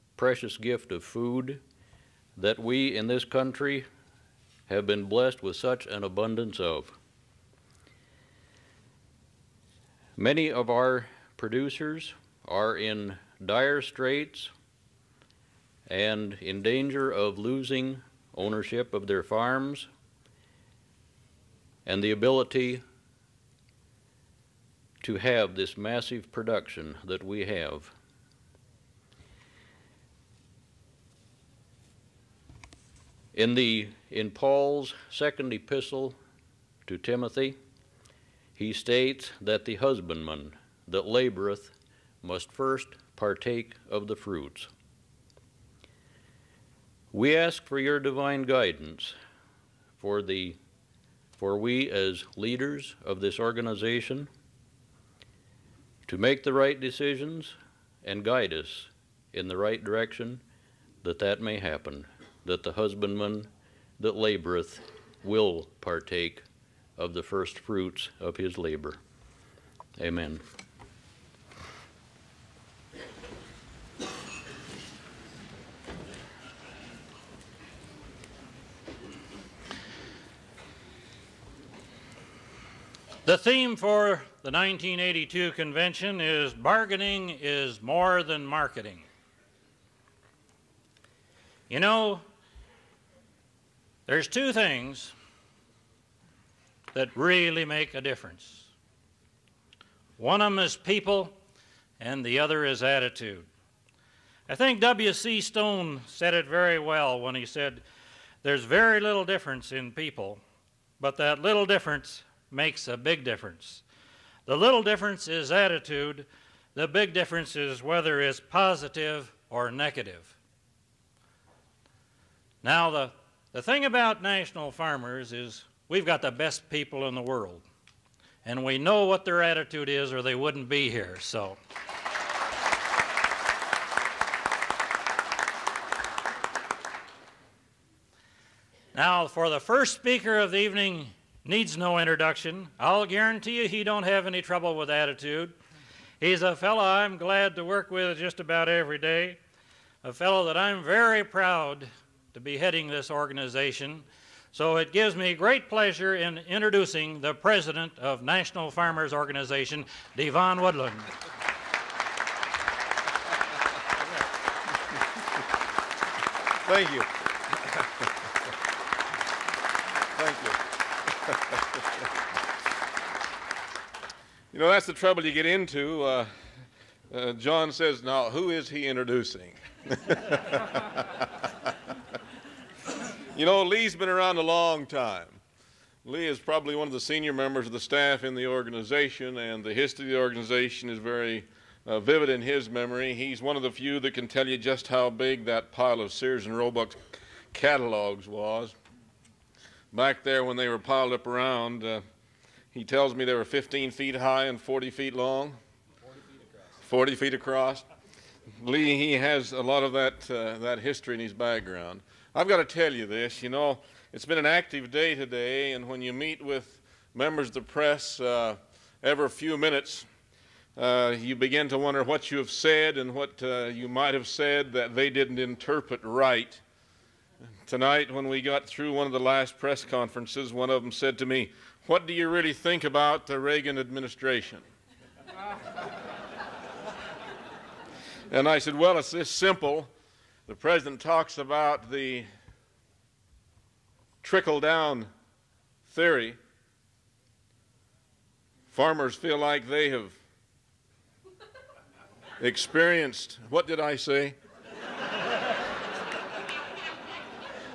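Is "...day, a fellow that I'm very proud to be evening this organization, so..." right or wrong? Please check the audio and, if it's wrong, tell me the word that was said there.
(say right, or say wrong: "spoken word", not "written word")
wrong: "heading", not "evening".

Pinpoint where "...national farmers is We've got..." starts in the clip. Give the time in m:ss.
2:04.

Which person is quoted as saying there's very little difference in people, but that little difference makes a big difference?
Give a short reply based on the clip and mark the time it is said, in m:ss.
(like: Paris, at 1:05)
W.C. Stone, at 1:44.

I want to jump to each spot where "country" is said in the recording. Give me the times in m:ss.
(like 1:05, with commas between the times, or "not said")
0:03.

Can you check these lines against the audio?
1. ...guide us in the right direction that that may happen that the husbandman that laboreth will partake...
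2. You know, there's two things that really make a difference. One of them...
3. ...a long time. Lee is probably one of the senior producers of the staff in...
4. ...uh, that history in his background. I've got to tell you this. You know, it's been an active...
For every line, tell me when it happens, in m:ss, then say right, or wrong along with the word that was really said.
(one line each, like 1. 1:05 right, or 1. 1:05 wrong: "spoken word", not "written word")
1. 0:58 right
2. 1:31 right
3. 3:04 wrong: "members", not "producers"
4. 3:30 right.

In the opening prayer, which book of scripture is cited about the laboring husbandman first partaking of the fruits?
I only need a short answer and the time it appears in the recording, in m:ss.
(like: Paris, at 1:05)
Paul's second epistle to Timothy, at 0:34.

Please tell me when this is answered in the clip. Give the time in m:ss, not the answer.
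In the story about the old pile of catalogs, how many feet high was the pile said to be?
3:23.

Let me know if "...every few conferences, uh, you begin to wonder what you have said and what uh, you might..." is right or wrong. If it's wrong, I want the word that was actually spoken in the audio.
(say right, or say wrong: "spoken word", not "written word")
wrong: "minutes", not "conferences".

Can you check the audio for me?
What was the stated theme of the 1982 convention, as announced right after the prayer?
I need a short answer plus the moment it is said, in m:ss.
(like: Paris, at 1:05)
Bargaining is more than marketing, at 1:26.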